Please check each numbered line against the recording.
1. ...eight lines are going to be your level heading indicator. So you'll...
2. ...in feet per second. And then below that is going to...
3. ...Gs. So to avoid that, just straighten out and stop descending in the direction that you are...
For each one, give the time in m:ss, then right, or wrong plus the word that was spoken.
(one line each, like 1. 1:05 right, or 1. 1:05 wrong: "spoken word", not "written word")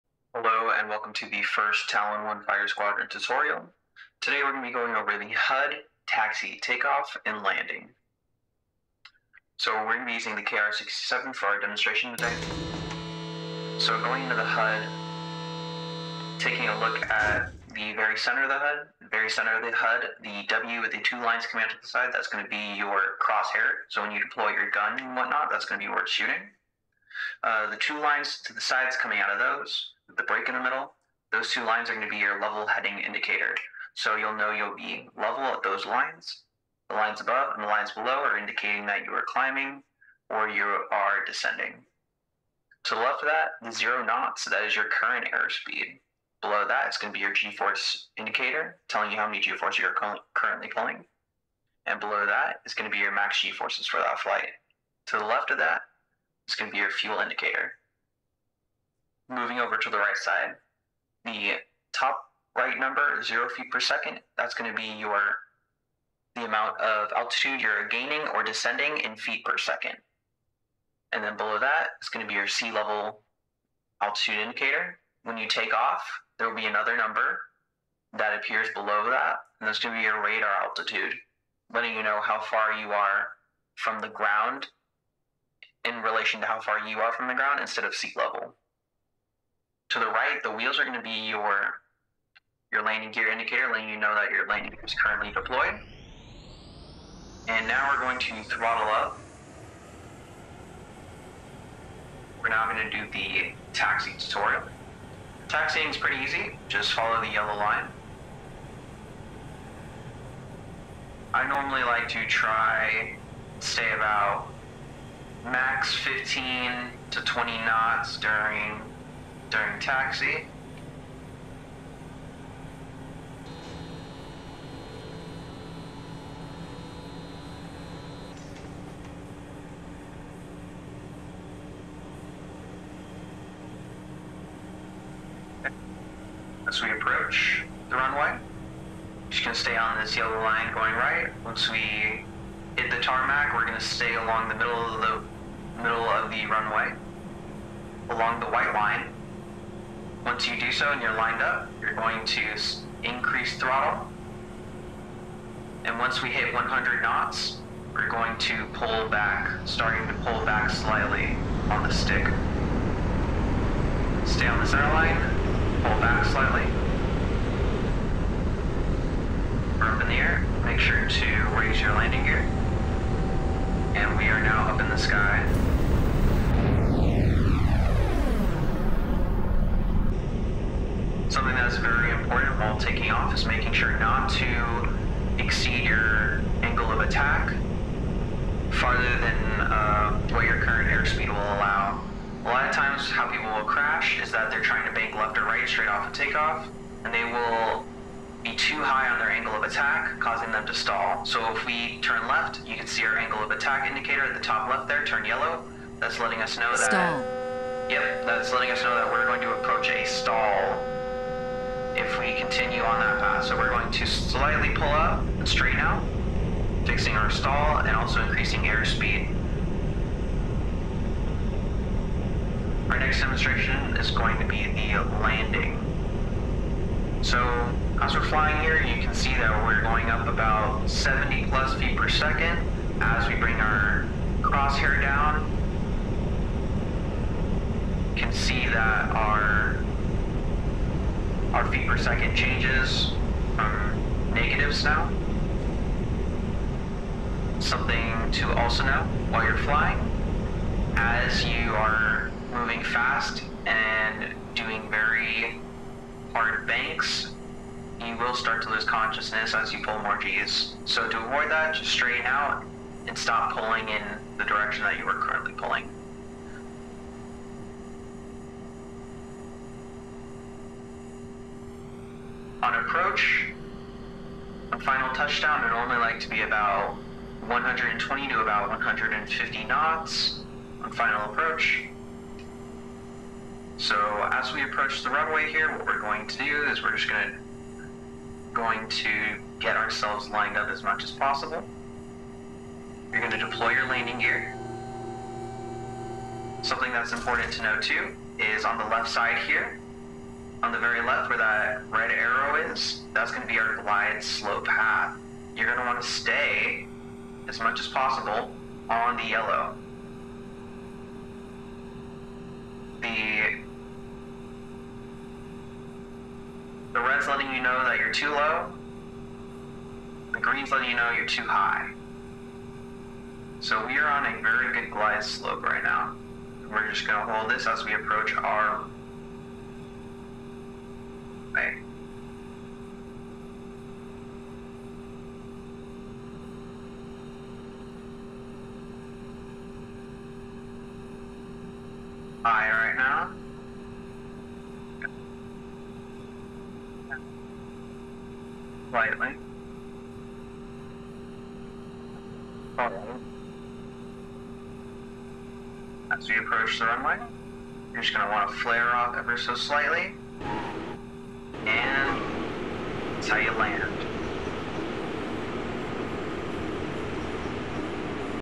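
1. 0:31 wrong: "two", not "eight"
2. 1:08 right
3. 4:20 wrong: "pulling", not "descending".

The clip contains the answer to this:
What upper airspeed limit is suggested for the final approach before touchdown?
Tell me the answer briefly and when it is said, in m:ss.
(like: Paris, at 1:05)
150 knots, at 4:38.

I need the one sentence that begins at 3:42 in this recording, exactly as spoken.
Our next demonstration is going to be the landing.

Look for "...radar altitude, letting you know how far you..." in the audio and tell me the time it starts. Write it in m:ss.
1:20.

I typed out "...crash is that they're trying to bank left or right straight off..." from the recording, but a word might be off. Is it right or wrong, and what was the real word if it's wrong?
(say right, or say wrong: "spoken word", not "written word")
right.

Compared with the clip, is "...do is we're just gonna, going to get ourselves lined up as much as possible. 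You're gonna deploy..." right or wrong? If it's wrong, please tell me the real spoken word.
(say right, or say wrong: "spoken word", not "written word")
right.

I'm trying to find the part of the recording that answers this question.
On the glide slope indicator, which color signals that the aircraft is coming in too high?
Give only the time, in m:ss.
5:20.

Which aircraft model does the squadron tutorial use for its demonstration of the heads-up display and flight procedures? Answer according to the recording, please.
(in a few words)
KR-67.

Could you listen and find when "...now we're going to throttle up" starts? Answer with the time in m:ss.
1:37.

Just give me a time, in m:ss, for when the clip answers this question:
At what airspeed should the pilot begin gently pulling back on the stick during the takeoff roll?
2:36.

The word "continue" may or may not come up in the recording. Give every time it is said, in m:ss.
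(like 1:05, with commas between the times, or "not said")
3:32.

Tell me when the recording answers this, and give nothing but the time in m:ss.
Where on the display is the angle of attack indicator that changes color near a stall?
3:24.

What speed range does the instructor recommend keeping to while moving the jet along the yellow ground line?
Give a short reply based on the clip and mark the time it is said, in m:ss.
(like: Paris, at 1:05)
15 to 20 knots, at 1:55.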